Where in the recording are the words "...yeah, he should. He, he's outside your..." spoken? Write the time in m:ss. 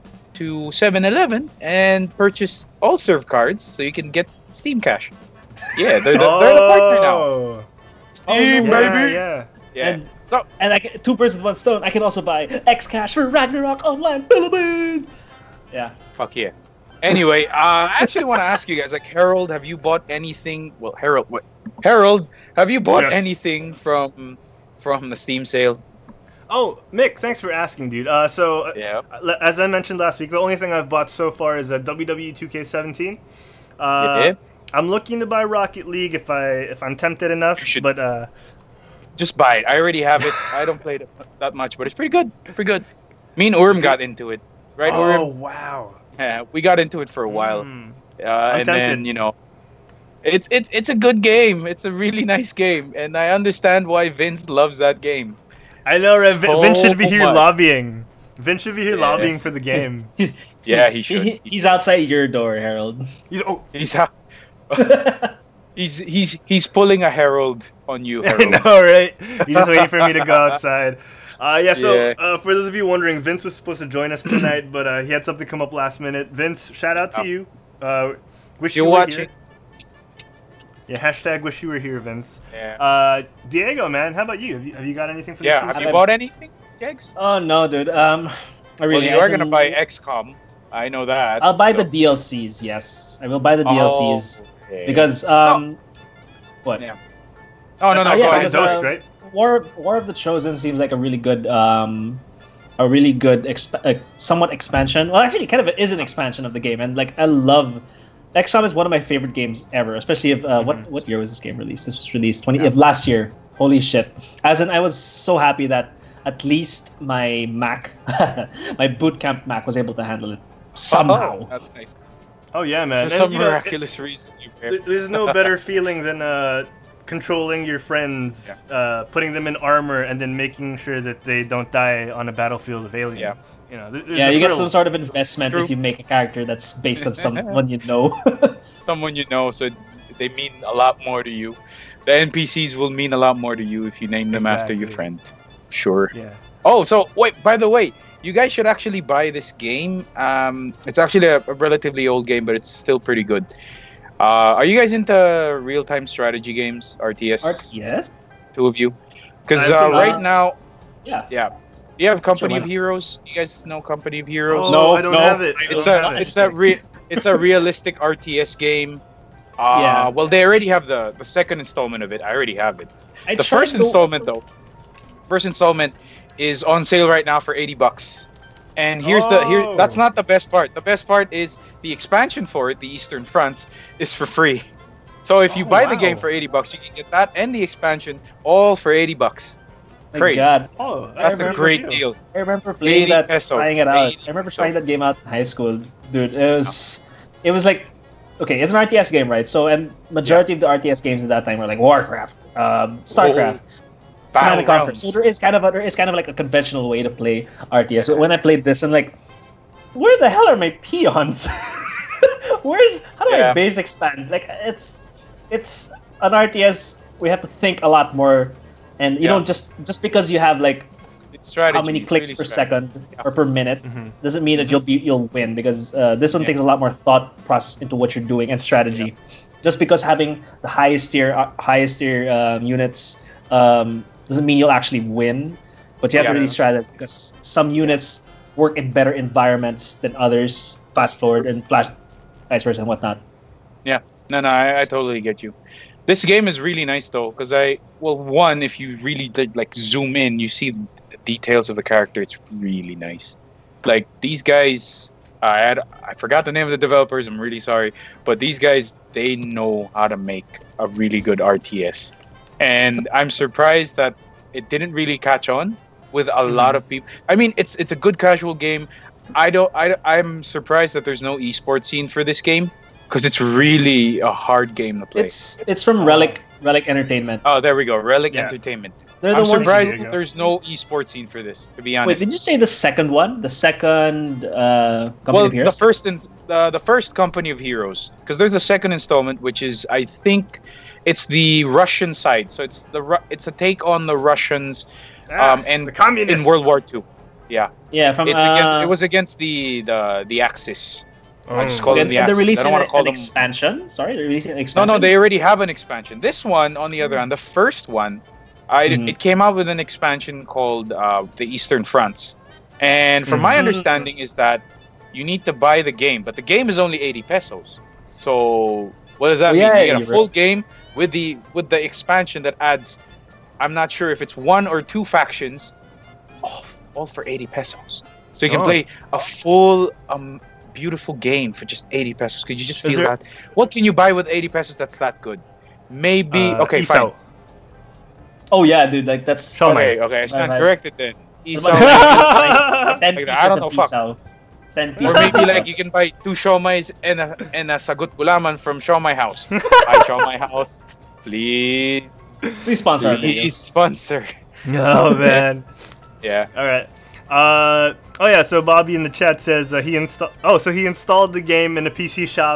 1:00.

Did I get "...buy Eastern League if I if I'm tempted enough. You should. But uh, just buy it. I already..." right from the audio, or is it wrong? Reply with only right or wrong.
wrong.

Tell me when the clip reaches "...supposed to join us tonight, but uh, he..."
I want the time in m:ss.
1:13.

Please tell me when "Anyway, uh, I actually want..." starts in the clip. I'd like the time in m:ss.
0:17.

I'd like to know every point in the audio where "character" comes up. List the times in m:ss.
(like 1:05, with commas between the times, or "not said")
2:16, 4:11.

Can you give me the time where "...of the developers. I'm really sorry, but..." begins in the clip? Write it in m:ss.
4:16.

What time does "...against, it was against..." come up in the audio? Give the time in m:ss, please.
4:58.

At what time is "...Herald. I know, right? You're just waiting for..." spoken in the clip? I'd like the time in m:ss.
1:08.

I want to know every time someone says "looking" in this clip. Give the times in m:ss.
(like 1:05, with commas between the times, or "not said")
0:34.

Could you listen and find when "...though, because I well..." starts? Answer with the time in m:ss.
4:07.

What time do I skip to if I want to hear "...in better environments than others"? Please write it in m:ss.
3:58.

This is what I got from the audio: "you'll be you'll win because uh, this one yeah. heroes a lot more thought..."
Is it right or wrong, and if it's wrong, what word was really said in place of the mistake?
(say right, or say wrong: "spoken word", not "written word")
wrong: "takes", not "heroes".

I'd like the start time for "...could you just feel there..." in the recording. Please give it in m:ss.
5:32.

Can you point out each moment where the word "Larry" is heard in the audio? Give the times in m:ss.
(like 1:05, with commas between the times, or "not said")
not said.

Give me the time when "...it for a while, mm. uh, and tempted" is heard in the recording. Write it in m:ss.
0:47.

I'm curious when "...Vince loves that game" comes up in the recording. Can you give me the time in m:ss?
0:54.